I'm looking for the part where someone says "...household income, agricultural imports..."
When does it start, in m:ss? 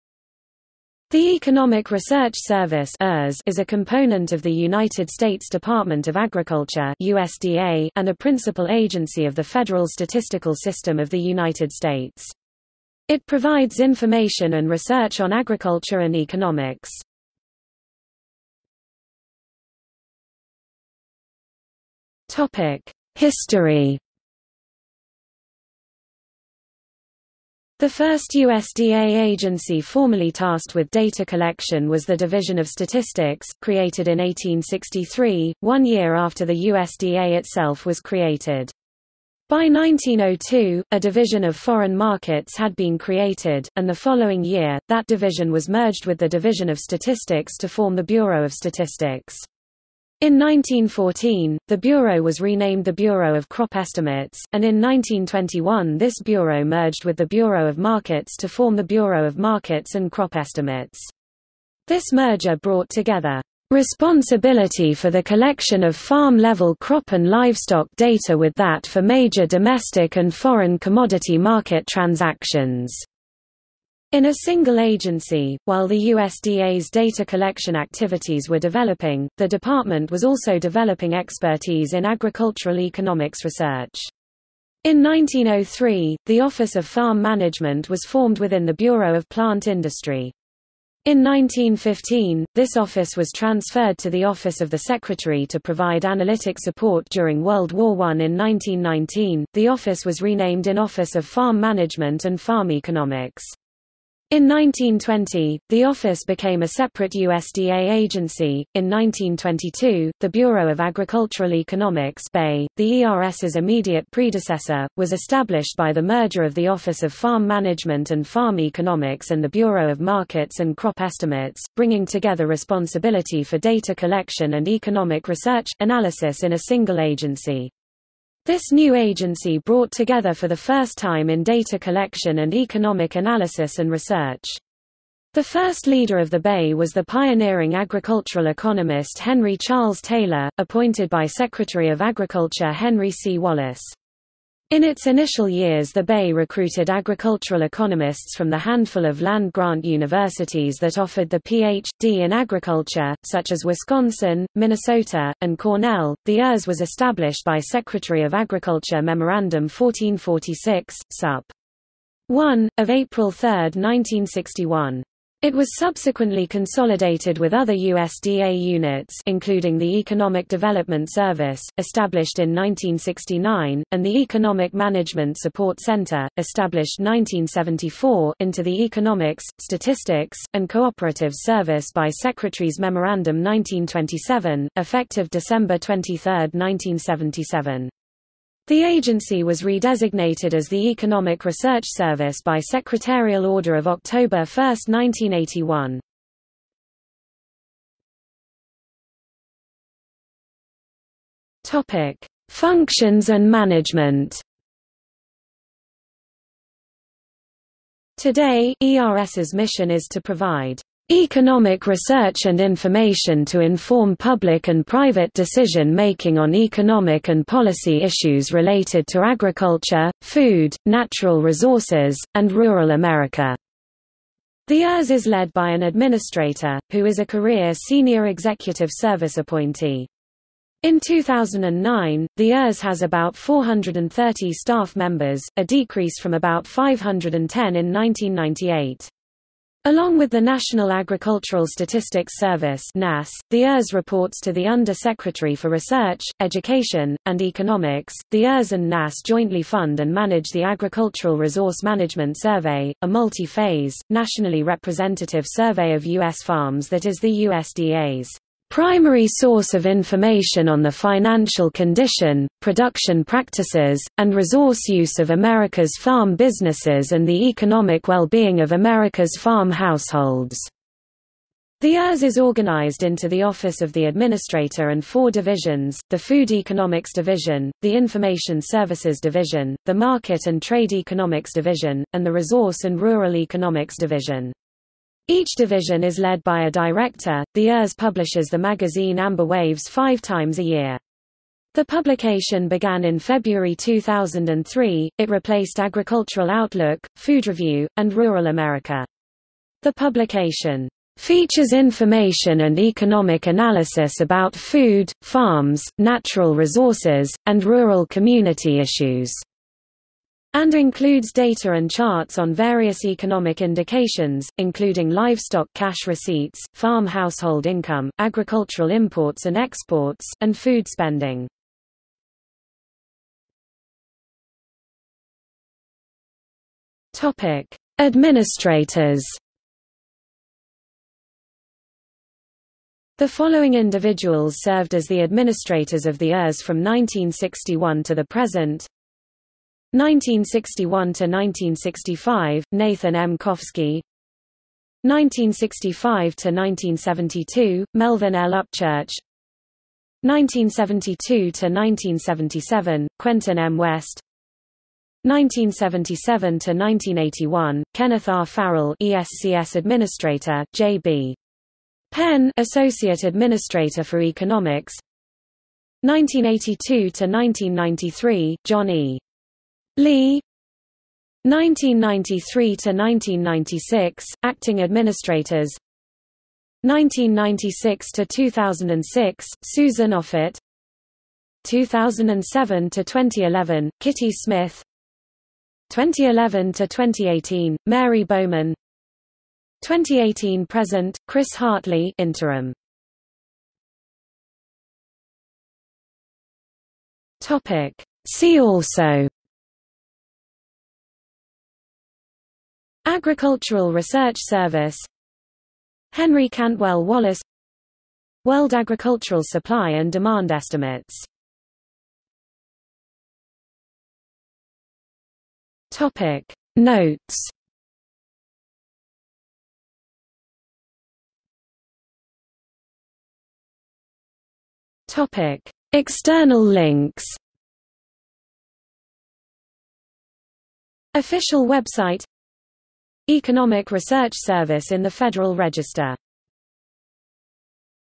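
5:17.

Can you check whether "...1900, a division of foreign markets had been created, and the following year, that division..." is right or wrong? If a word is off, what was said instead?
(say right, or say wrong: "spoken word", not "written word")
wrong: "1902", not "1900".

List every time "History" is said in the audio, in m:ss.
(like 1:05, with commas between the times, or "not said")
0:23.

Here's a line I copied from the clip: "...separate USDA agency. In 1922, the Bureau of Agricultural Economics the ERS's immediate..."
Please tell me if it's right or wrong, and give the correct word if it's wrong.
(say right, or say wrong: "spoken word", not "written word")
right.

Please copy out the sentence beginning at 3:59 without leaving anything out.
Along with the National Agricultural Statistics Service NASS, the ERS reports to the Under-Secretary for Research, Education, and Economics.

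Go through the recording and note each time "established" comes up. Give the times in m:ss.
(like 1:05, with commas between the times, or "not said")
1:55, 2:36, 2:51, 2:56.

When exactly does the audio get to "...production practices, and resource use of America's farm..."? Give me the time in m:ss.
4:22.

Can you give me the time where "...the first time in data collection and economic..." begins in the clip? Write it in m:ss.
2:10.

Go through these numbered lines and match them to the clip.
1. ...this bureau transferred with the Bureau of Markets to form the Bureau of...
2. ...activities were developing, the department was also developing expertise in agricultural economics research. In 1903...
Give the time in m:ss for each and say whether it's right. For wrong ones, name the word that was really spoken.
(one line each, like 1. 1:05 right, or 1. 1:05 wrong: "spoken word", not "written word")
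1. 0:55 wrong: "merged", not "transferred"
2. 1:17 right.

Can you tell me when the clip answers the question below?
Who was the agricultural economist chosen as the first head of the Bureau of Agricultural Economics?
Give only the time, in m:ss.
2:19.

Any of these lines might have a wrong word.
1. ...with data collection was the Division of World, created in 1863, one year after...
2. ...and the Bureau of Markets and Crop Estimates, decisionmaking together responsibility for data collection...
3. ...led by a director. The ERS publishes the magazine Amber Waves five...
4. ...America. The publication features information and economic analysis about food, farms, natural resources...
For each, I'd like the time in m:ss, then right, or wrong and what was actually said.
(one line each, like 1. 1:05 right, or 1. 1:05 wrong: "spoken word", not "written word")
1. 0:30 wrong: "Statistics", not "World"
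2. 1:59 wrong: "bringing", not "decisionmaking"
3. 4:46 right
4. 4:58 right.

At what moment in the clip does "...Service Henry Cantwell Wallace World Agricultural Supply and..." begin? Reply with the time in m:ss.
6:44.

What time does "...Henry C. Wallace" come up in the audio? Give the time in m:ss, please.
2:22.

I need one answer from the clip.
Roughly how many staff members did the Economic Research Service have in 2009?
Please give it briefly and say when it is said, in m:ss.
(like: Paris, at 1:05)
430, at 3:53.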